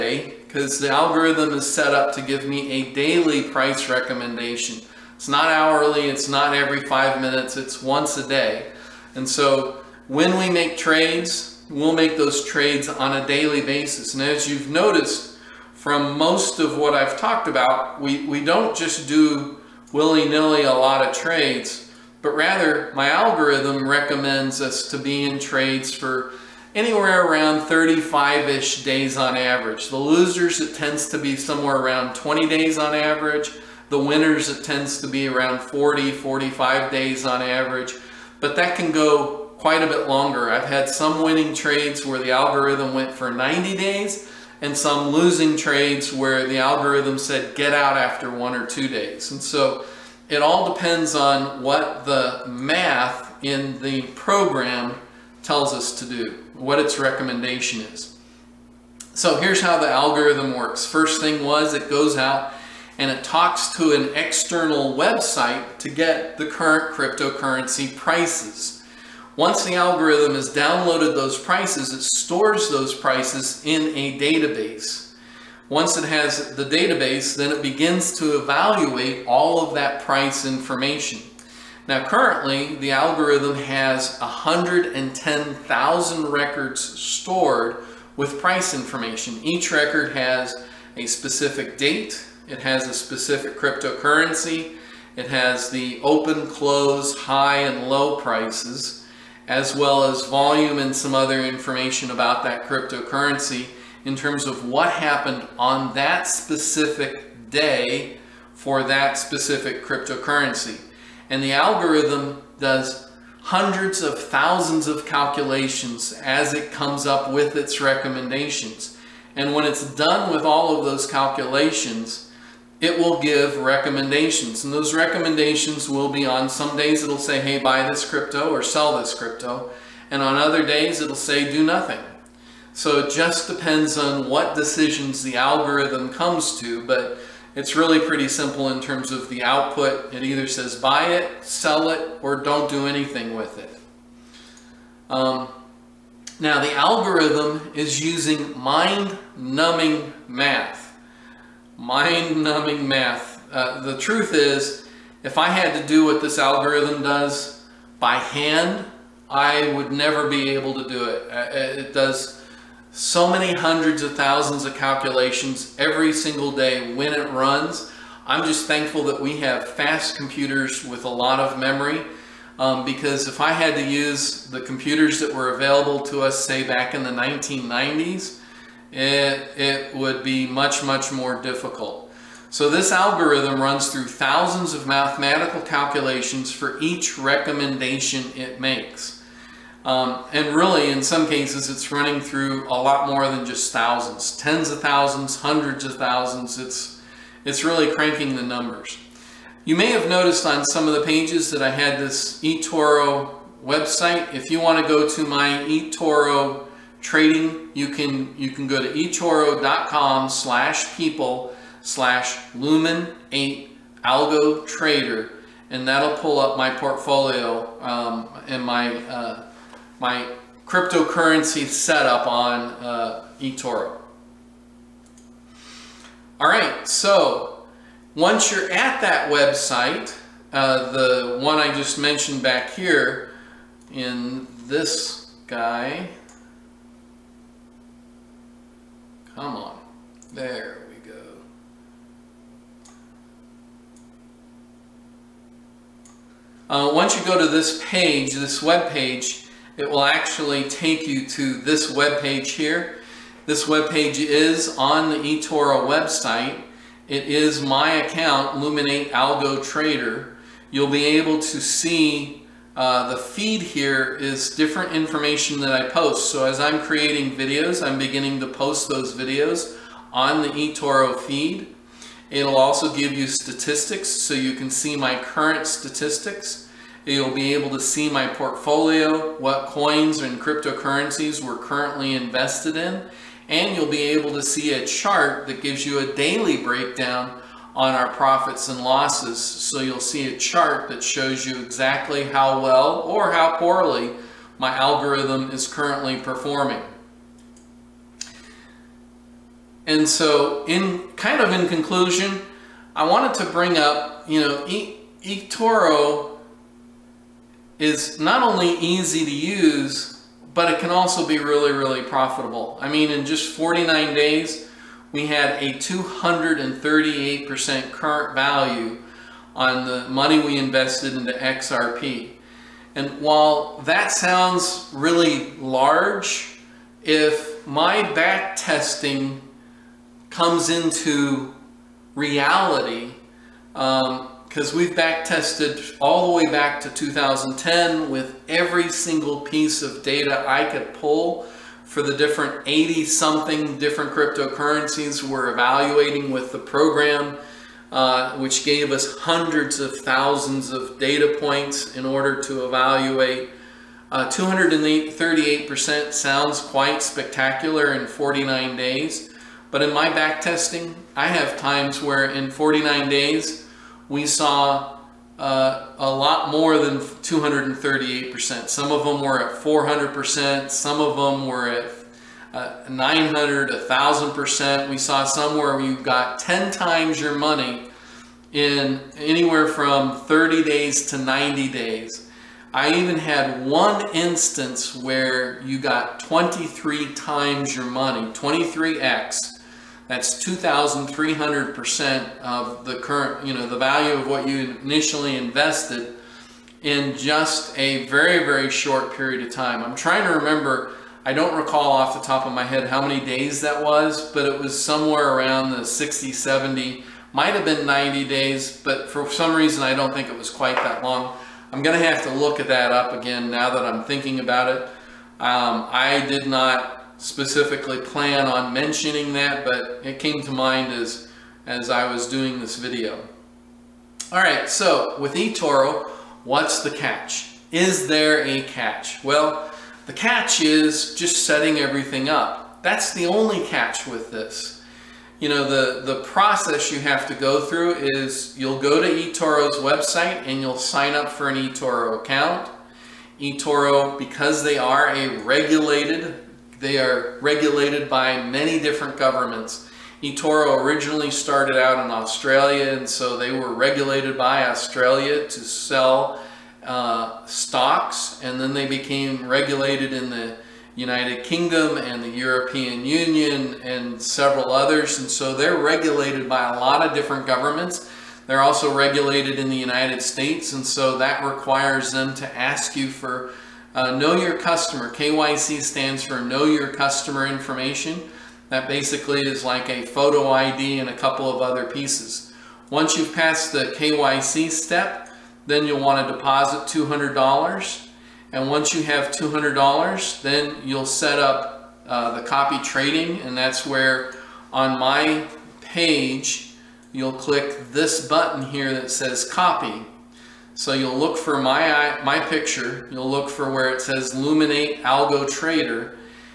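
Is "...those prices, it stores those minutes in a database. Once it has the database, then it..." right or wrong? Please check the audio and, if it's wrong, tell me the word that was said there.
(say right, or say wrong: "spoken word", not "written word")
wrong: "prices", not "minutes".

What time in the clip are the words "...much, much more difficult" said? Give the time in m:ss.
3:00.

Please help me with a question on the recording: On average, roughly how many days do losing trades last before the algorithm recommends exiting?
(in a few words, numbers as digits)
20 days.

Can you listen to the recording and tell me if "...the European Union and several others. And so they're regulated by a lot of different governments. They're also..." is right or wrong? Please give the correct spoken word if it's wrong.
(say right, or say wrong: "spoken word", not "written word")
right.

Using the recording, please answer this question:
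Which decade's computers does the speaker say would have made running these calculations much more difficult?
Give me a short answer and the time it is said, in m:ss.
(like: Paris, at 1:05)
1990s, at 2:57.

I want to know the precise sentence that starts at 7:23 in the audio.
eToro, because they are a regulated they are regulated by many different governments.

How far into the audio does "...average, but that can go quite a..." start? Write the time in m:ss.
0:37.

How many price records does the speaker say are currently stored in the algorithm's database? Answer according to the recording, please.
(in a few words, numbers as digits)
110,000.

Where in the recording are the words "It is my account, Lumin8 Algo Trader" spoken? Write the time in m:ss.
4:17.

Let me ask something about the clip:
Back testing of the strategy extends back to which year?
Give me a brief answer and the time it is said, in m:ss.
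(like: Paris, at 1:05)
2010, at 5:36.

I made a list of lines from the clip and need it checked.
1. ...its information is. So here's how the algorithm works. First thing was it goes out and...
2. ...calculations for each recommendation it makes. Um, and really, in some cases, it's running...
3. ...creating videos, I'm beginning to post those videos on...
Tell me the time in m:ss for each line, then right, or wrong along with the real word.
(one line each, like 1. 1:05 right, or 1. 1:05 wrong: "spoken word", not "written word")
1. 0:56 wrong: "recommendation", not "information"
2. 3:05 right
3. 4:26 right.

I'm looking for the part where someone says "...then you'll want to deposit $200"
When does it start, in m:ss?
8:05.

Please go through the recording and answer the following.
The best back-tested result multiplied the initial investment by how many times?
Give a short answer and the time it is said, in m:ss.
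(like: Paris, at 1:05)
23 times, at 6:26.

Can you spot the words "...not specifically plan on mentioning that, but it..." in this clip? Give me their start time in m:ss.
6:56.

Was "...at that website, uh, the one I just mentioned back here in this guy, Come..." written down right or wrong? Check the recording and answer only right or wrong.
right.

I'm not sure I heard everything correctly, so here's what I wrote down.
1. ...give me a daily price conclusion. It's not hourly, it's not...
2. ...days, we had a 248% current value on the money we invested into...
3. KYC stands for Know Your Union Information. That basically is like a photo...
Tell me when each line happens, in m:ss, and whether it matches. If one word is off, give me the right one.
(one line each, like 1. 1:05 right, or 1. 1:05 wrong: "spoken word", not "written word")
1. 0:02 wrong: "recommendation", not "conclusion"
2. 5:14 wrong: "238", not "248"
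3. 7:55 wrong: "Customer", not "Union".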